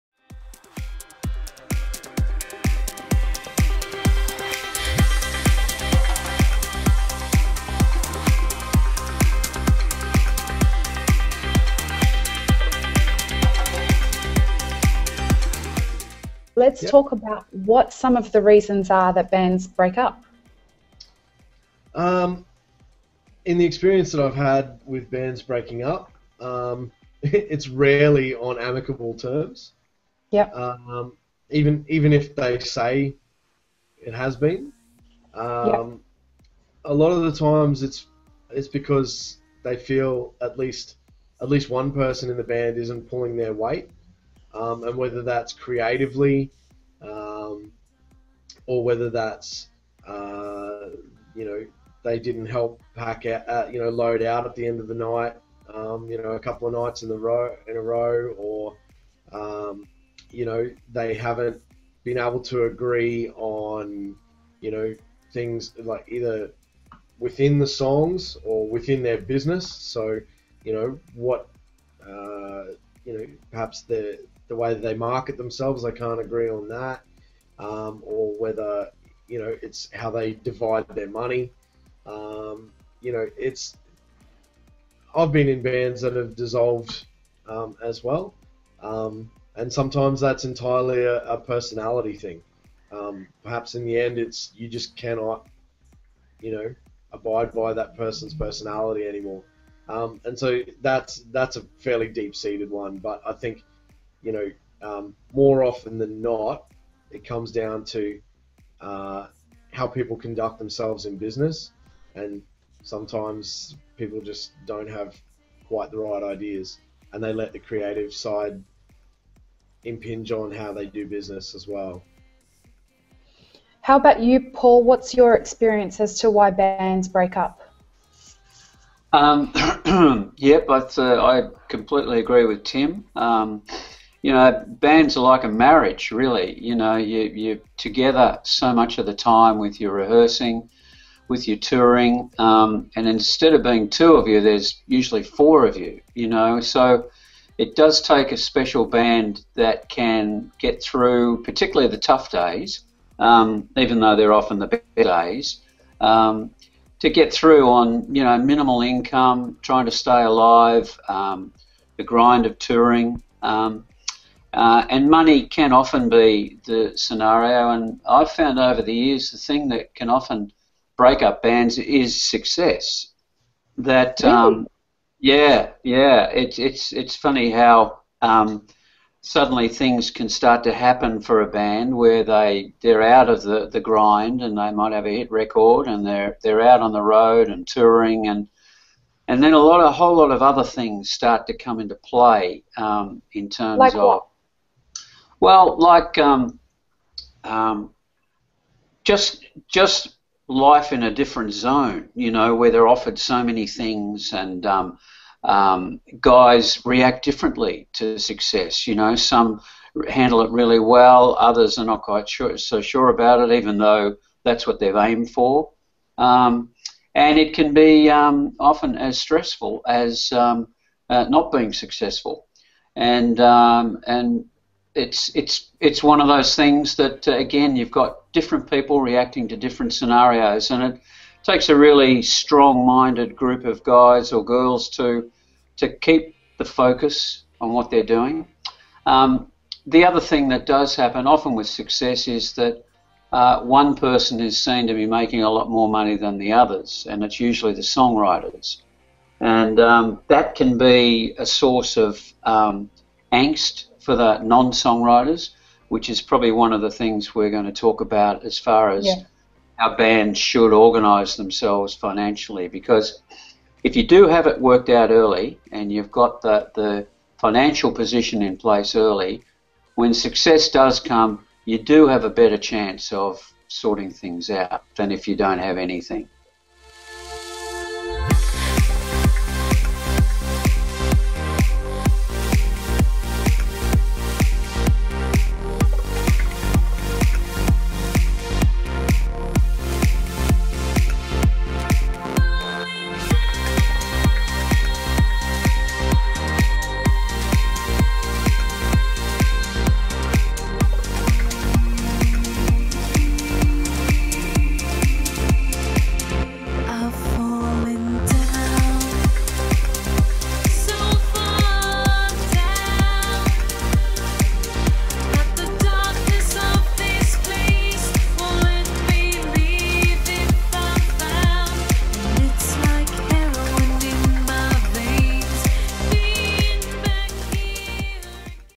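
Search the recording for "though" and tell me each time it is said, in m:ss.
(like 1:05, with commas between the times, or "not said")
2:33, 3:33.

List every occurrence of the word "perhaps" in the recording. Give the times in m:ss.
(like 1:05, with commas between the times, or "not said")
1:13, 1:33.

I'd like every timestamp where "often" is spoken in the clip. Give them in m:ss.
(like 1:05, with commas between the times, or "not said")
1:45, 2:34, 2:45, 2:50, 3:38, 4:01.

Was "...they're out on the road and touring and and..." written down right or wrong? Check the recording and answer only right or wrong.
right.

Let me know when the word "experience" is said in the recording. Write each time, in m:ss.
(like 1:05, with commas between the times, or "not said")
0:23, 2:05.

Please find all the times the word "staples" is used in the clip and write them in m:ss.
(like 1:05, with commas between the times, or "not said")
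not said.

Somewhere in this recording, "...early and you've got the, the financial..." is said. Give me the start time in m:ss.
4:25.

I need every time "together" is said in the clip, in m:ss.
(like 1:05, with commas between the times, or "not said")
2:17.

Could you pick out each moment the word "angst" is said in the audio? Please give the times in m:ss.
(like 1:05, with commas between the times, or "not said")
4:13.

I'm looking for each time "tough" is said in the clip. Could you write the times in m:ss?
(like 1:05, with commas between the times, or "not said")
2:31.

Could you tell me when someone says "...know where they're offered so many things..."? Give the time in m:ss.
3:22.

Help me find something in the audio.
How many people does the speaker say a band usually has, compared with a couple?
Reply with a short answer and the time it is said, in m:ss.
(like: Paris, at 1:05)
4, at 2:25.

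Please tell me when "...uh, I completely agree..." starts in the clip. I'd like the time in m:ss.
2:10.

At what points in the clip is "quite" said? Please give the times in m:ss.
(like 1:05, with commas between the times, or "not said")
1:55, 3:32.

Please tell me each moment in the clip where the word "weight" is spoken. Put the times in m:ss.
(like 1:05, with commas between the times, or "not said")
0:43.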